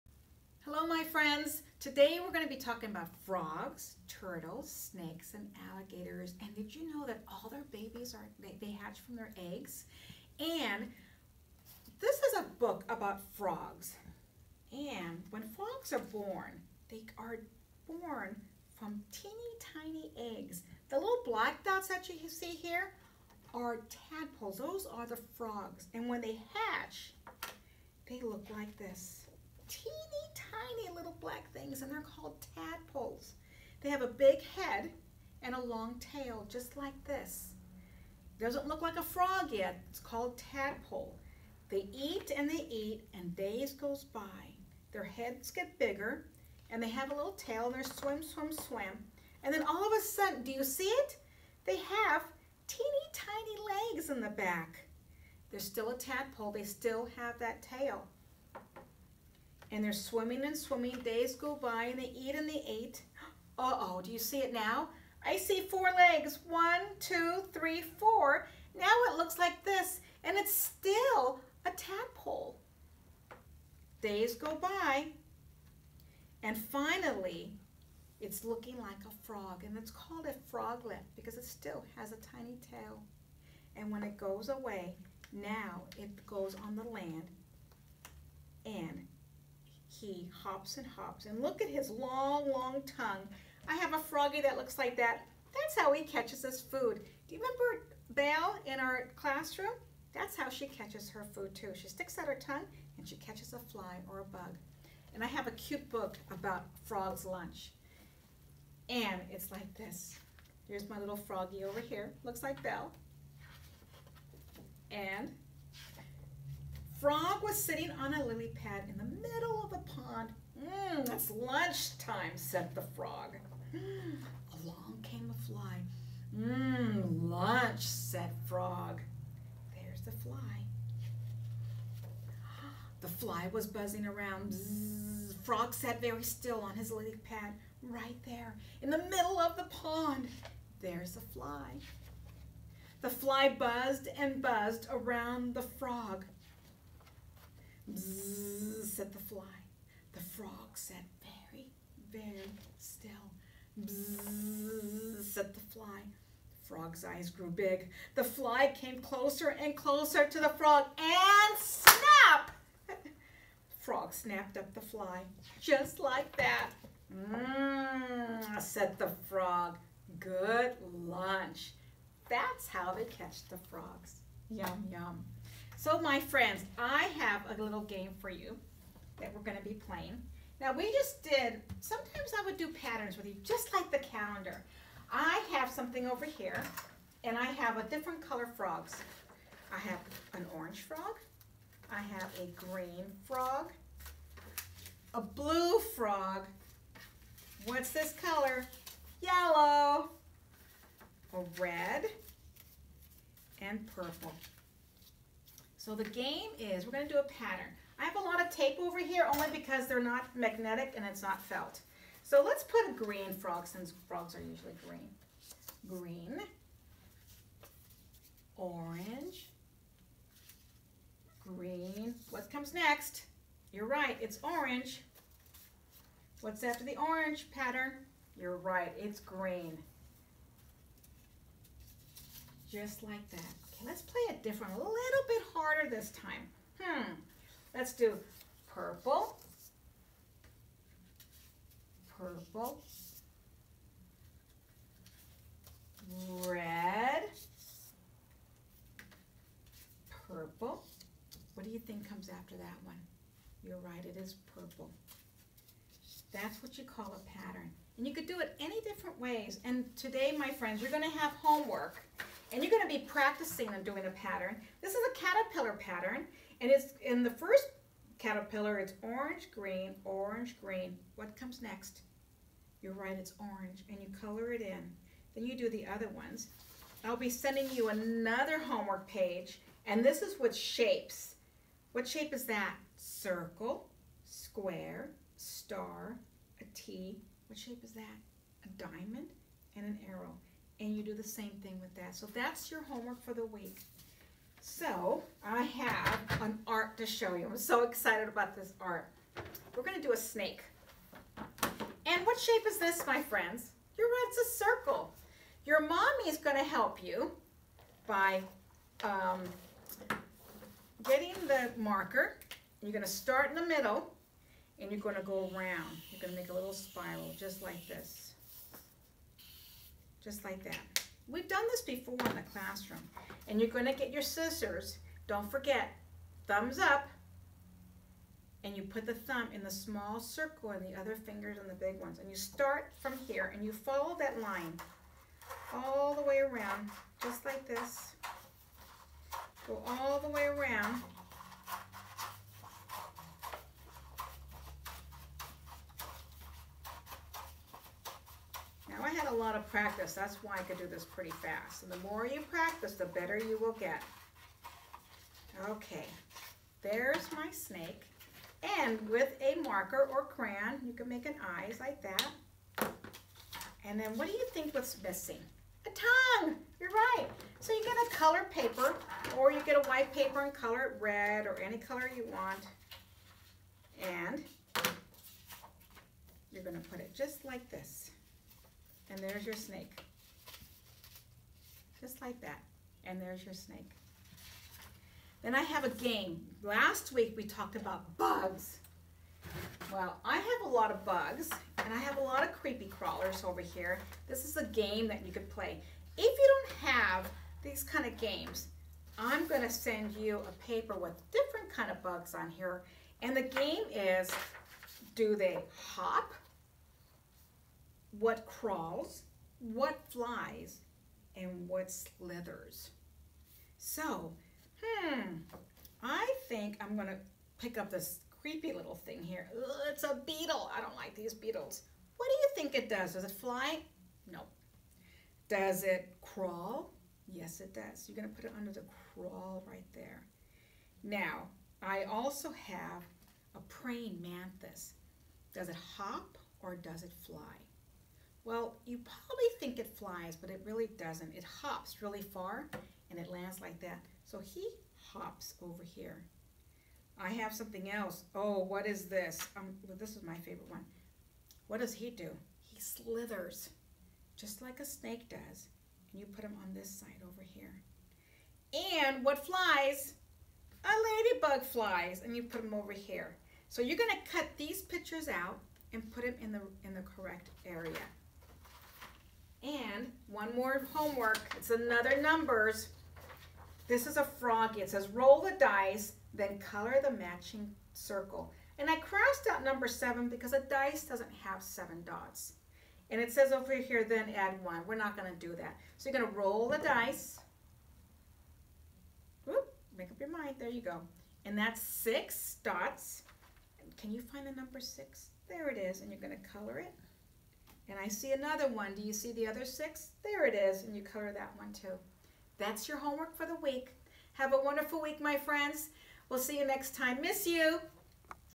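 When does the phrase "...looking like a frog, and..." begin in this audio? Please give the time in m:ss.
1:18.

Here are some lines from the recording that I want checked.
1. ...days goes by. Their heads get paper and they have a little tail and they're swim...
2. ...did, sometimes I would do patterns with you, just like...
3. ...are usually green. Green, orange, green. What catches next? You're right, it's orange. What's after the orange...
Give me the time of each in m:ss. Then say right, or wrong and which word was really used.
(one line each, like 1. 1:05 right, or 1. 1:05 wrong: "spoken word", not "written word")
1. 0:43 wrong: "bigger", not "paper"
2. 3:01 right
3. 3:34 wrong: "comes", not "catches".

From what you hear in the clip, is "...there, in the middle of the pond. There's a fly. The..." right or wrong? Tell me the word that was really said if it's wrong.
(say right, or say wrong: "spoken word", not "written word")
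right.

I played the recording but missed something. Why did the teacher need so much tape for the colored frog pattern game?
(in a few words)
they're not magnetic.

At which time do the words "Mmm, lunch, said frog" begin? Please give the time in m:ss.
2:06.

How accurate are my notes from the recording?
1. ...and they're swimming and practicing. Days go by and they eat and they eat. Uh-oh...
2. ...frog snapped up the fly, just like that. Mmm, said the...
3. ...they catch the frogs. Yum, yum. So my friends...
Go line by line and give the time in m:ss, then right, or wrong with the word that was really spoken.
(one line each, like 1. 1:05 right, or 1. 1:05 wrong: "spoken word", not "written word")
1. 0:59 wrong: "swimming", not "practicing"
2. 2:43 right
3. 2:52 right.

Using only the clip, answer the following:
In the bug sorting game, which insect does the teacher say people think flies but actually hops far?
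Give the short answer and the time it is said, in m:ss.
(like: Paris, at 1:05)
praying mantis, at 7:13.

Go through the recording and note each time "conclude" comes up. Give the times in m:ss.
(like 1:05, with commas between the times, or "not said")
not said.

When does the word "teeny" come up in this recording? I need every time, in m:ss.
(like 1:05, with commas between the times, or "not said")
0:19, 0:29, 0:52.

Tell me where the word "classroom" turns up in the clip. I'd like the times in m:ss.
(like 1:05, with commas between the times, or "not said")
1:39, 5:22.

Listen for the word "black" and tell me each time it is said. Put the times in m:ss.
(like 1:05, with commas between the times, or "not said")
0:21, 0:31.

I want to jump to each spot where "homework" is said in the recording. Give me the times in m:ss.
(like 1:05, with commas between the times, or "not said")
4:21, 4:38, 4:52, 7:50, 8:22.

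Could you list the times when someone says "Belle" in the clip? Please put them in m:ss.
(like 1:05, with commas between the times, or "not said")
1:38, 1:52.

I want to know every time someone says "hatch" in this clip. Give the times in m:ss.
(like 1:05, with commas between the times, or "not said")
0:08, 0:26.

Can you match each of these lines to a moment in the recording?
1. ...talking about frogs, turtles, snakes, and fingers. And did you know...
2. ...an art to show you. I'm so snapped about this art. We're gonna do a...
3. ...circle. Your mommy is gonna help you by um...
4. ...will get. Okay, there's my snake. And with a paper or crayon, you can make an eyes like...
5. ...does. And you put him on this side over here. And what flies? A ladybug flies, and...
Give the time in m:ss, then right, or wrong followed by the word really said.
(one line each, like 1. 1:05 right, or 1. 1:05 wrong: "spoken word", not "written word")
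1. 0:02 wrong: "alligators", not "fingers"
2. 4:56 wrong: "excited", not "snapped"
3. 5:04 right
4. 5:53 wrong: "marker", not "paper"
5. 7:35 right.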